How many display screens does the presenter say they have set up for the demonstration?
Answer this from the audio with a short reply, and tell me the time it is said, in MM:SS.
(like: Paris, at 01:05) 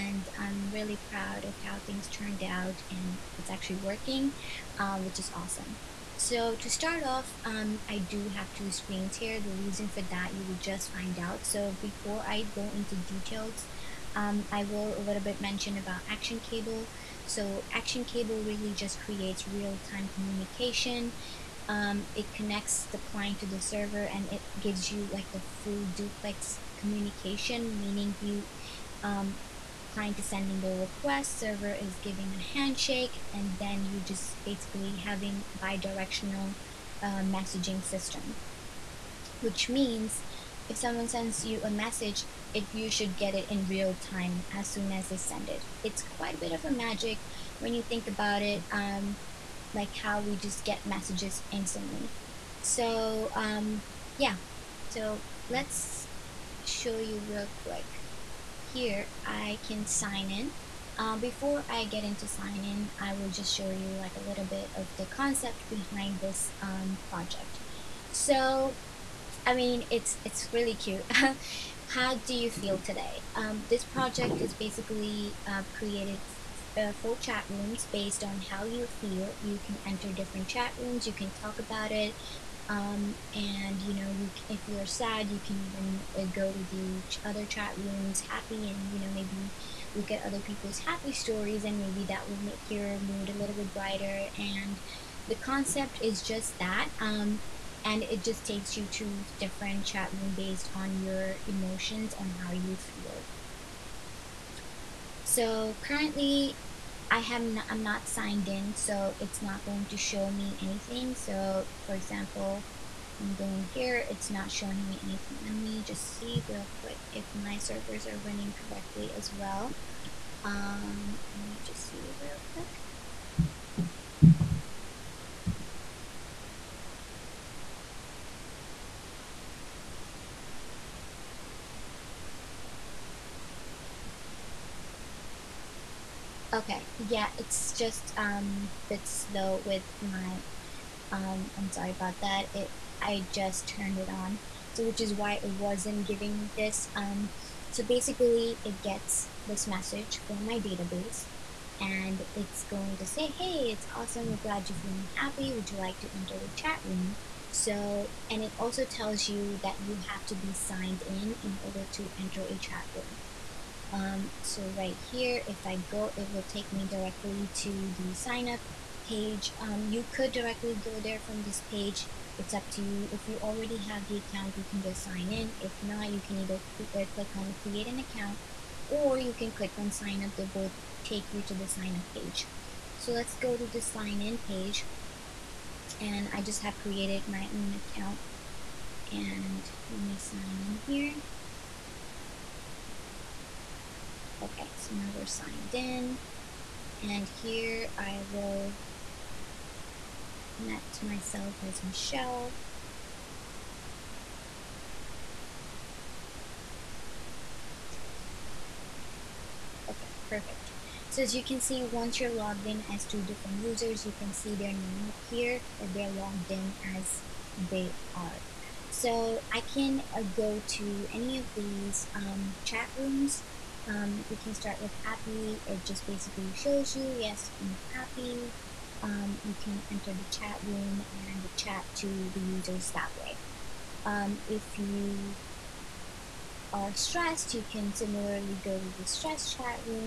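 2, at 00:08.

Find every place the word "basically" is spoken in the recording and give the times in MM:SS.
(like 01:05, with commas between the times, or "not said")
00:34, 01:14, 02:27, 03:46.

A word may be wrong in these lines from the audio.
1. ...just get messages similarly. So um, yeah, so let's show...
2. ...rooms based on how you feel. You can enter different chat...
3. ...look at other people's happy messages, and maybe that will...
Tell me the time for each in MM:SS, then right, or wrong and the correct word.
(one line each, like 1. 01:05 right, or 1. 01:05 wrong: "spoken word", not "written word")
1. 00:50 wrong: "instantly", not "similarly"
2. 01:17 right
3. 01:29 wrong: "stories", not "messages".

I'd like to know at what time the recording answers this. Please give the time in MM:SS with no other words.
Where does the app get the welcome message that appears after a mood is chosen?
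02:30.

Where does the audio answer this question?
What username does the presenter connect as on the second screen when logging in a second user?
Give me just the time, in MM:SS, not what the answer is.
03:21.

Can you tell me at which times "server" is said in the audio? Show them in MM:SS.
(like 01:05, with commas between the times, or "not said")
00:23, 00:31, 01:57.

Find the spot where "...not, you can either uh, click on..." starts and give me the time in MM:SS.
02:55.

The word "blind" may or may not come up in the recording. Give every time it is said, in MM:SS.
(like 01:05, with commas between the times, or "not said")
not said.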